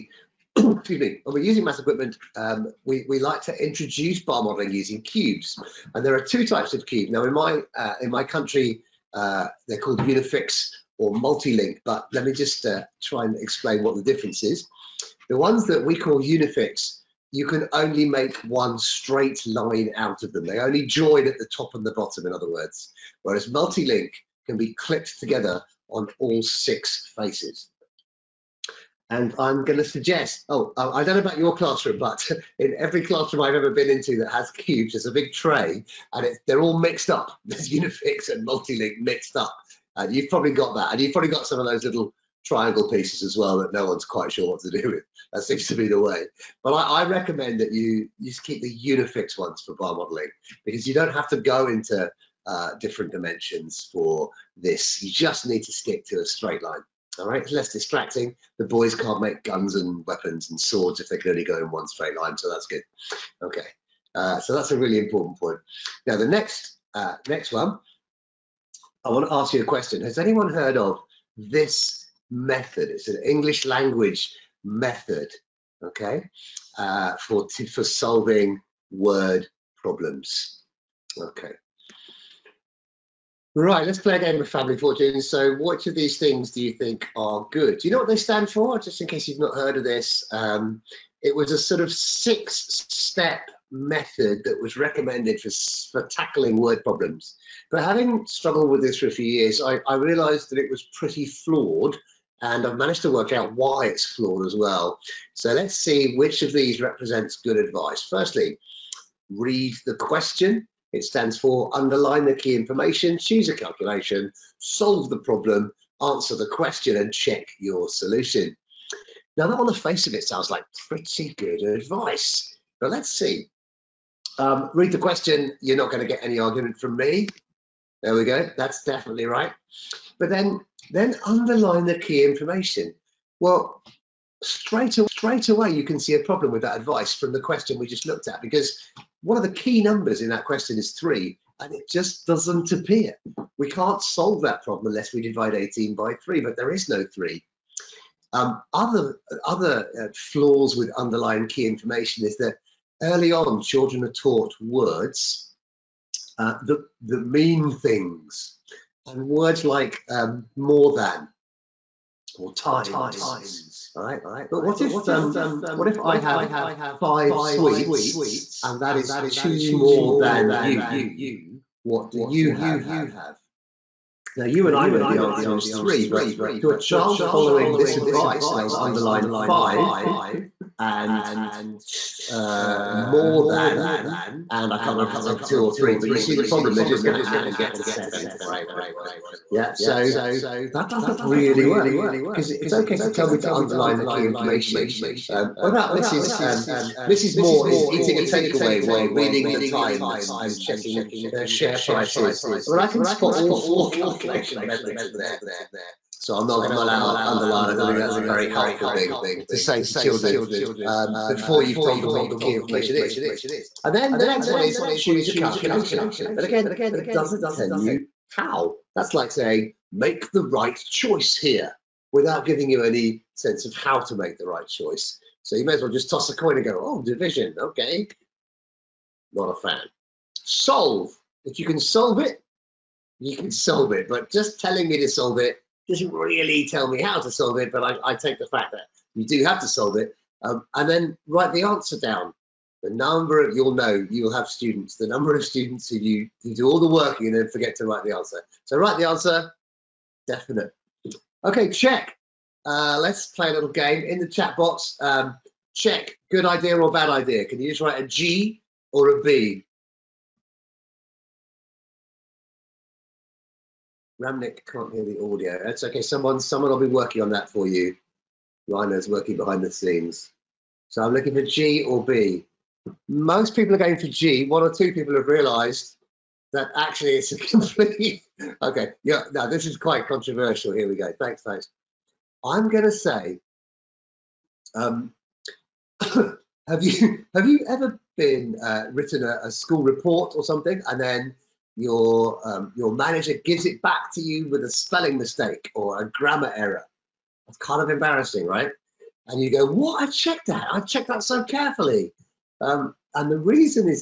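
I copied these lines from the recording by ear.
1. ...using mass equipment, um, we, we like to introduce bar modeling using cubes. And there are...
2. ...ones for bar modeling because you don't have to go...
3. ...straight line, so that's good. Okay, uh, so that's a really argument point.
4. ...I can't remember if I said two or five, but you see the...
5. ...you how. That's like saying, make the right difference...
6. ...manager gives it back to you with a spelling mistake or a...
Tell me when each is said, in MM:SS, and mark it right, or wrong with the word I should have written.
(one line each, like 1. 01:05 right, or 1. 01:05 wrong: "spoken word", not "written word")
1. 00:01 right
2. 00:49 right
3. 01:01 wrong: "important", not "argument"
4. 03:04 wrong: "three", not "five"
5. 03:37 wrong: "choice", not "difference"
6. 04:52 right.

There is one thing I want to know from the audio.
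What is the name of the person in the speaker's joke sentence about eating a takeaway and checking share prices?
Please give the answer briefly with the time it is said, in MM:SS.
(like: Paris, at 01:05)
Mrs. Moore, at 03:17.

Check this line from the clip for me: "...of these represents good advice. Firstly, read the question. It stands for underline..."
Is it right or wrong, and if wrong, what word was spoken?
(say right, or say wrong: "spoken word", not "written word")
right.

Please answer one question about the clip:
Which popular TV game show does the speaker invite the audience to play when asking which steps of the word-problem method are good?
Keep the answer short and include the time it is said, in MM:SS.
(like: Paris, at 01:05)
Family Fortune, at 01:24.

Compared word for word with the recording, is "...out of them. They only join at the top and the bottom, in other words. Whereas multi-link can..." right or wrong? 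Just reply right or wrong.
right.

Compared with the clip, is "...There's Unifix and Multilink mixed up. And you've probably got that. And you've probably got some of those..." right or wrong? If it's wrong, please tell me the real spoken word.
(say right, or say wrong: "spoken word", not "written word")
right.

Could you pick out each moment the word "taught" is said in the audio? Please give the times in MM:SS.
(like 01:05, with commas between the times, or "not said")
02:34.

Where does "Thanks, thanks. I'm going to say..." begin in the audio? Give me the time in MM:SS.
04:41.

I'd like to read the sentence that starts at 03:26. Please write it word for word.
So I'm not going to allow underline.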